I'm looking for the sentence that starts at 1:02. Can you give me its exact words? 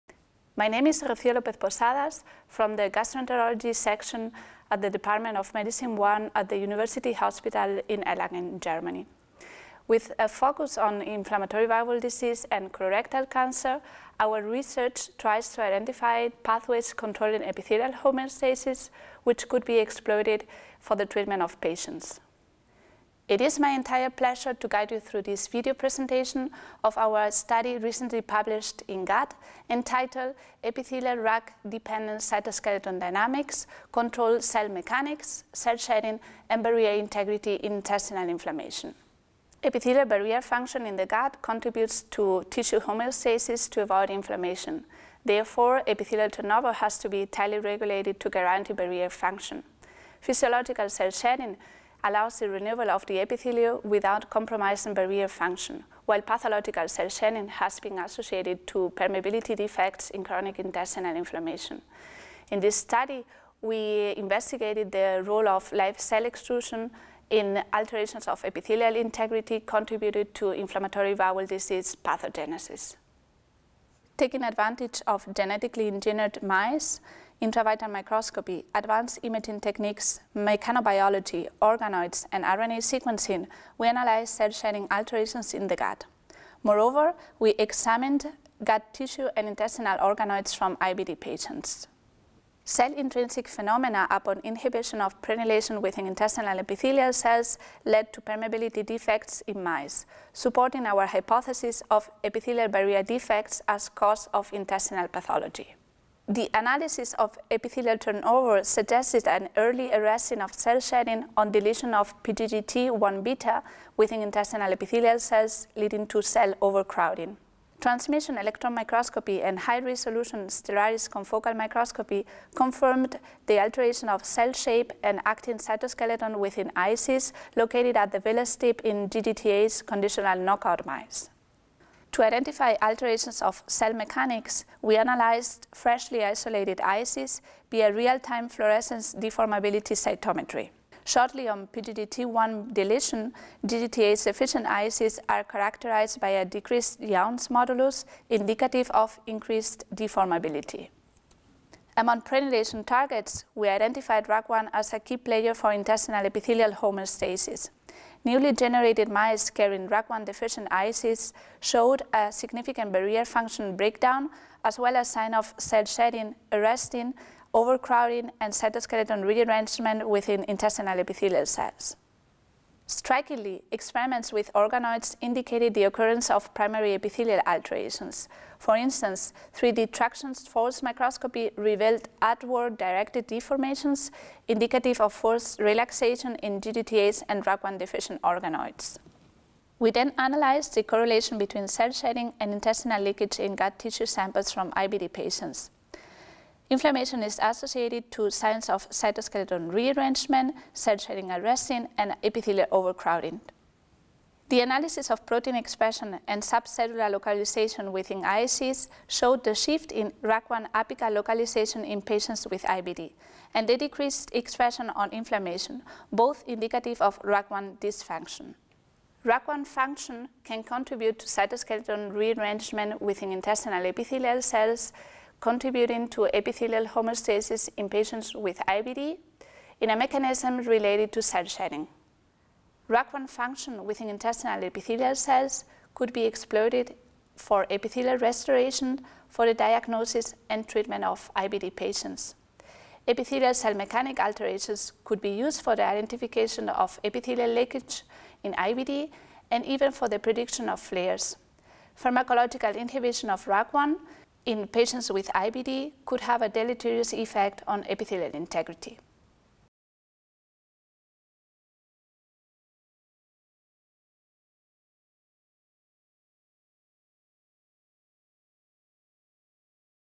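In this study, we investigated the role of live cell extrusion in alterations of epithelial integrity contributed to inflammatory bowel disease pathogenesis.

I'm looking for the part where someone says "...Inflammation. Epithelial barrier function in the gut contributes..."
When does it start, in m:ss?
0:38.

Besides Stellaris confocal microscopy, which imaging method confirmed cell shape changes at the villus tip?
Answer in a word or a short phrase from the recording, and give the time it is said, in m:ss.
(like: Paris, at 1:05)
Transmission electron microscopy, at 1:57.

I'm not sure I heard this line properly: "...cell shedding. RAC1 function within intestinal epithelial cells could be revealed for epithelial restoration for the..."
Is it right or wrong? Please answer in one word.
wrong.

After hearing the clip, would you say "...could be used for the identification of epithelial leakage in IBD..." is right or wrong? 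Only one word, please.
right.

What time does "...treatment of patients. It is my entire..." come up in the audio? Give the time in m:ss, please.
0:21.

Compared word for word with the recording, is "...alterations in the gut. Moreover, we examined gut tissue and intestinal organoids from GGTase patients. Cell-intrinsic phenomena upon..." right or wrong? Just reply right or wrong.
wrong.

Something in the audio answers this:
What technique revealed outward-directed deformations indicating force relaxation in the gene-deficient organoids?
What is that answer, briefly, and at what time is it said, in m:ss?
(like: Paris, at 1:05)
3D traction force microscopy, at 2:59.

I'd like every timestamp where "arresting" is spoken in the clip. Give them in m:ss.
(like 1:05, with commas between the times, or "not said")
1:49, 2:46.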